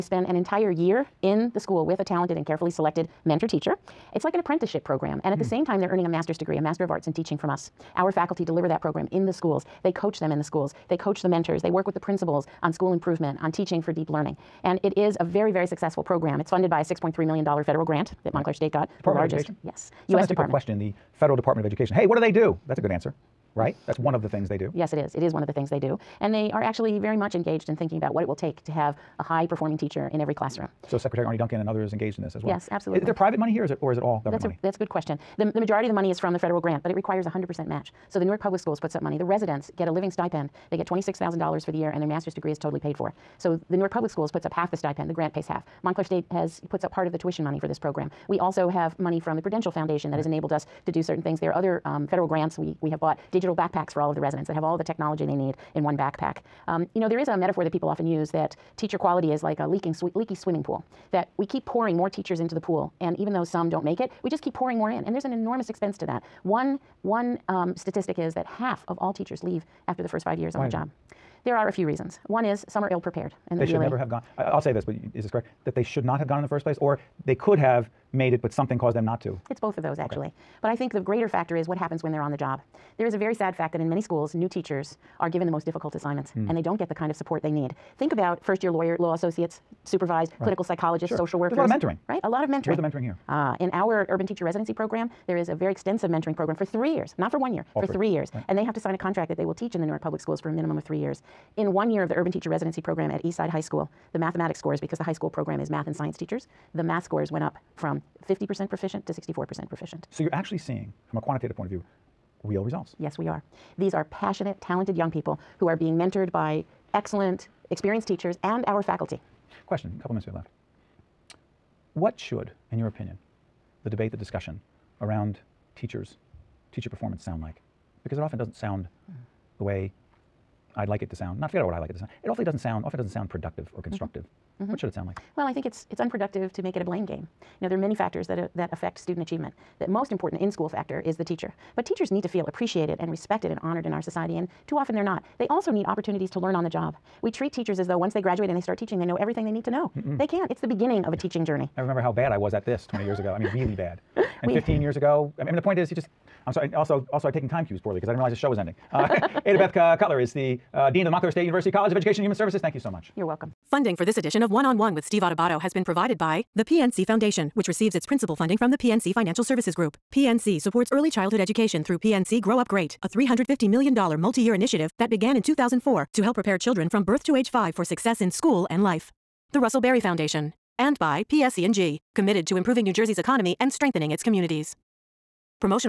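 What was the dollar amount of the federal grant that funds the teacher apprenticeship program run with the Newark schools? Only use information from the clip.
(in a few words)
$6.3 million.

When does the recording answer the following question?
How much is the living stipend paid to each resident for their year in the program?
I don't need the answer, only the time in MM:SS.
00:40.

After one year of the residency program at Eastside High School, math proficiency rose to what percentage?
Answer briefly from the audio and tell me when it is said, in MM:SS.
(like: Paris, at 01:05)
64%, at 01:49.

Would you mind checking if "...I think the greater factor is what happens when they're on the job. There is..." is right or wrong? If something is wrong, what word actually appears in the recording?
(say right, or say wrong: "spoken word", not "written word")
right.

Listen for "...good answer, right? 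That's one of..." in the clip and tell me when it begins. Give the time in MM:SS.
00:22.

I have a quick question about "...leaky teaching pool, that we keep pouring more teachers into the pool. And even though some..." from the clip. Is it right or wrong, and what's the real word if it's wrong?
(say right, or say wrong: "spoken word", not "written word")
wrong: "swimming", not "teaching".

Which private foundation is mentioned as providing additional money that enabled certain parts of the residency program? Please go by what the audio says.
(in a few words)
Prudential Foundation.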